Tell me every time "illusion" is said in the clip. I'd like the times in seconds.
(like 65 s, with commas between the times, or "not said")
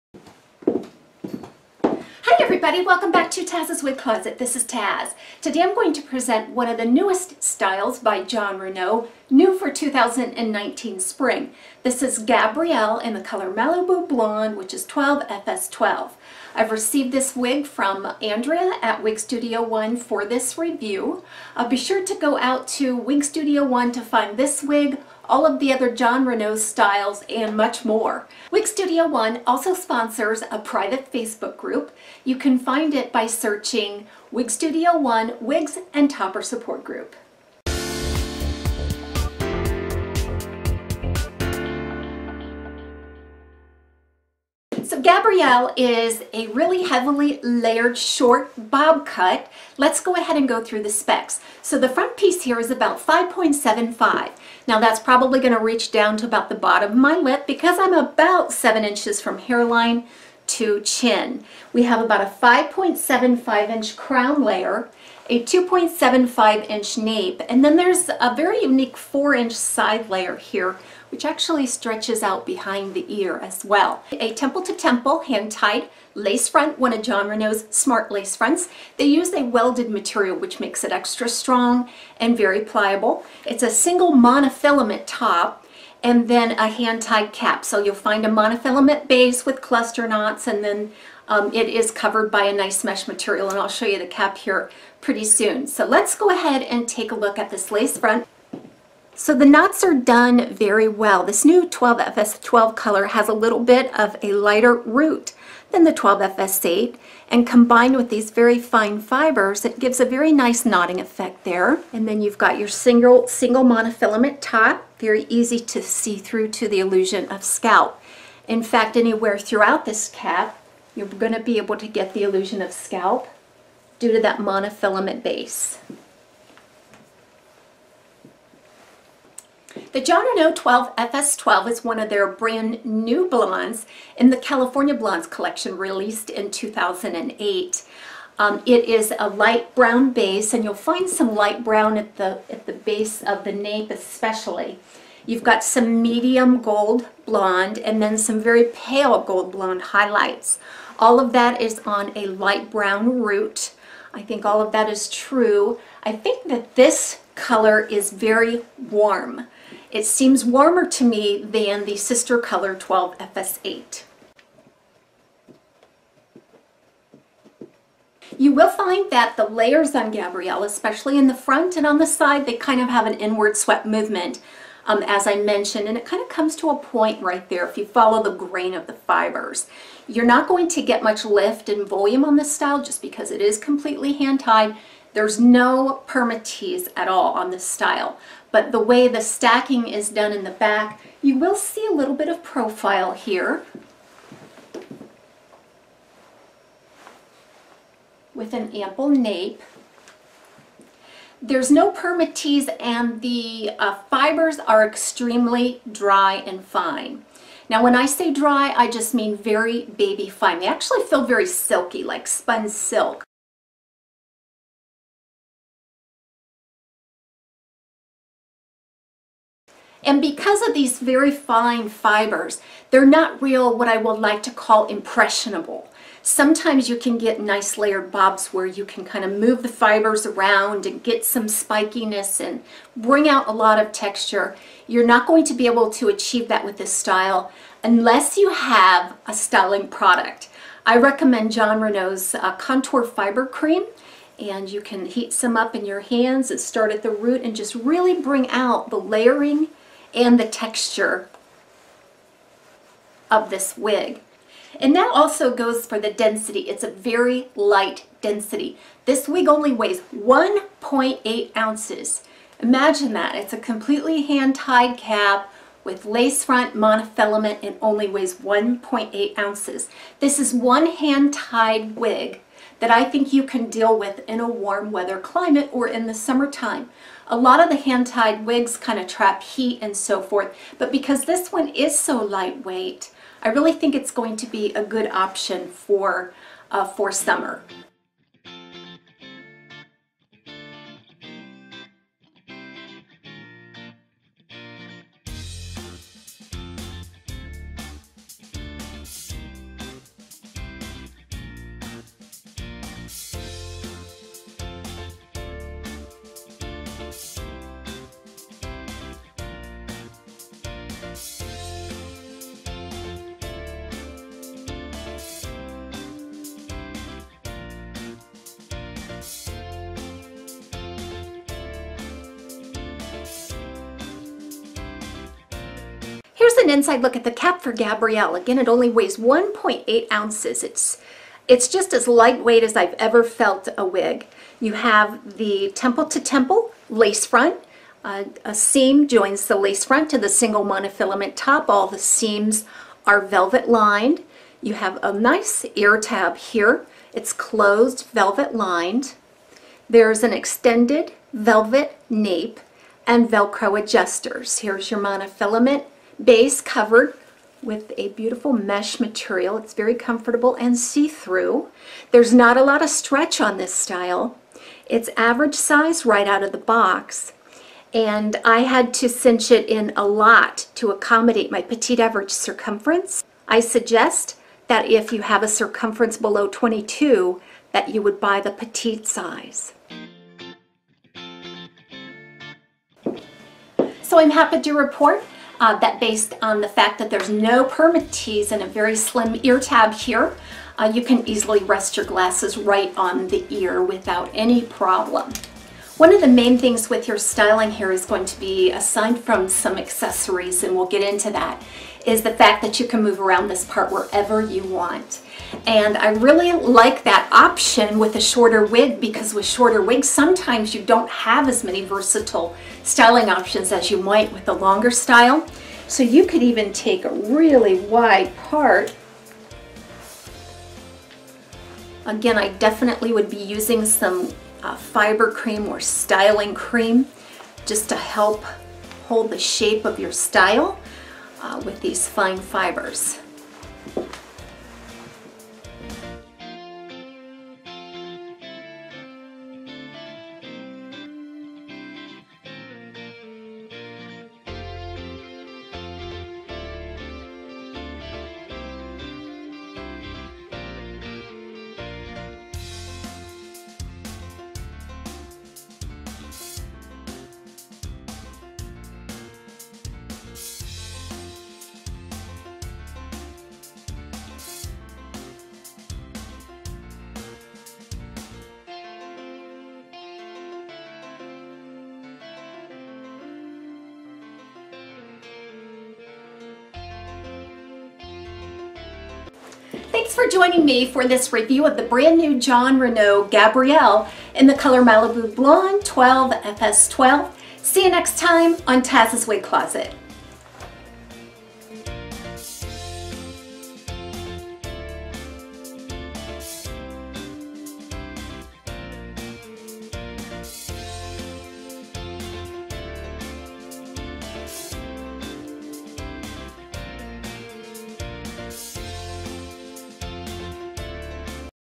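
116 s, 122 s.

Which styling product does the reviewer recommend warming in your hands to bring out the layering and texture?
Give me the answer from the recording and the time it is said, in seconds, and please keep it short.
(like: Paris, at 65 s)
Contour Fiber Cream, at 242 s.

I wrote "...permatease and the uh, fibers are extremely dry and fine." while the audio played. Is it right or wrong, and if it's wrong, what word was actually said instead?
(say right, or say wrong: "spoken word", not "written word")
right.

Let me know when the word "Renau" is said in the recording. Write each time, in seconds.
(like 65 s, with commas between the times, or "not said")
8 s, 26 s, 77 s, 130 s, 241 s, 482 s.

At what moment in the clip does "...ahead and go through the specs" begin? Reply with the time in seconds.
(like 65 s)
50 s.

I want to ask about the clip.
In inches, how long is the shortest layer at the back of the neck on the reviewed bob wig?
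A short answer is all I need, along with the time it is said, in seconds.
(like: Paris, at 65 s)
2.75 inches, at 65 s.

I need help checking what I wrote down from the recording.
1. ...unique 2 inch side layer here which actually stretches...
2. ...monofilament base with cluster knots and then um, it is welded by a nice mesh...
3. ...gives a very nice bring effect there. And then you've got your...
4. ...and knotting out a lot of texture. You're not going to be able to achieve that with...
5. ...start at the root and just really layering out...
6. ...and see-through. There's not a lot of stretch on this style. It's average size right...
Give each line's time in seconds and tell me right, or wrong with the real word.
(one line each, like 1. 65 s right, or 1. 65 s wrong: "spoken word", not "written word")
1. 68 s wrong: "4", not "2"
2. 88 s wrong: "covered", not "welded"
3. 109 s wrong: "knotting", not "bring"
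4. 232 s wrong: "bring", not "knotting"
5. 246 s wrong: "bring", not "layering"
6. 360 s right.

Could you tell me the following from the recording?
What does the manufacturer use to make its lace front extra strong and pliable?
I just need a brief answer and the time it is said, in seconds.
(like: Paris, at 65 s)
welded material, at 79 s.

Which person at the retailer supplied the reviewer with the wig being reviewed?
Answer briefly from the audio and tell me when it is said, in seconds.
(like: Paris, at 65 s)
Andrea, at 18 s.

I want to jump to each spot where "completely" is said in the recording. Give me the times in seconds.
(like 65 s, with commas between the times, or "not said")
183 s, 263 s.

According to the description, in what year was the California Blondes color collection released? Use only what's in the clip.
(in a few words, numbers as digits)
2008.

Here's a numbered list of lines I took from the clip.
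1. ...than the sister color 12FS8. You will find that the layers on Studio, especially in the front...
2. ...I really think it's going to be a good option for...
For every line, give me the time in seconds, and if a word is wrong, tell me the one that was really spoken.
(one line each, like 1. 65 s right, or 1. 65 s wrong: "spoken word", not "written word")
1. 161 s wrong: "Gabrielle", not "Studio"
2. 283 s right.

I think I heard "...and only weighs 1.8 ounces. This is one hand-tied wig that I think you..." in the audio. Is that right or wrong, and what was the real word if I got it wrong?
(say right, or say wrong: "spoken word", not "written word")
right.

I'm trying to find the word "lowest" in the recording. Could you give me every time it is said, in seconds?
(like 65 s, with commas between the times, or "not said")
not said.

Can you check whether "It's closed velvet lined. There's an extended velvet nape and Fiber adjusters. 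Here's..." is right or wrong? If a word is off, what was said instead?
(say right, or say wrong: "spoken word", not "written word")
wrong: "Velcro", not "Fiber".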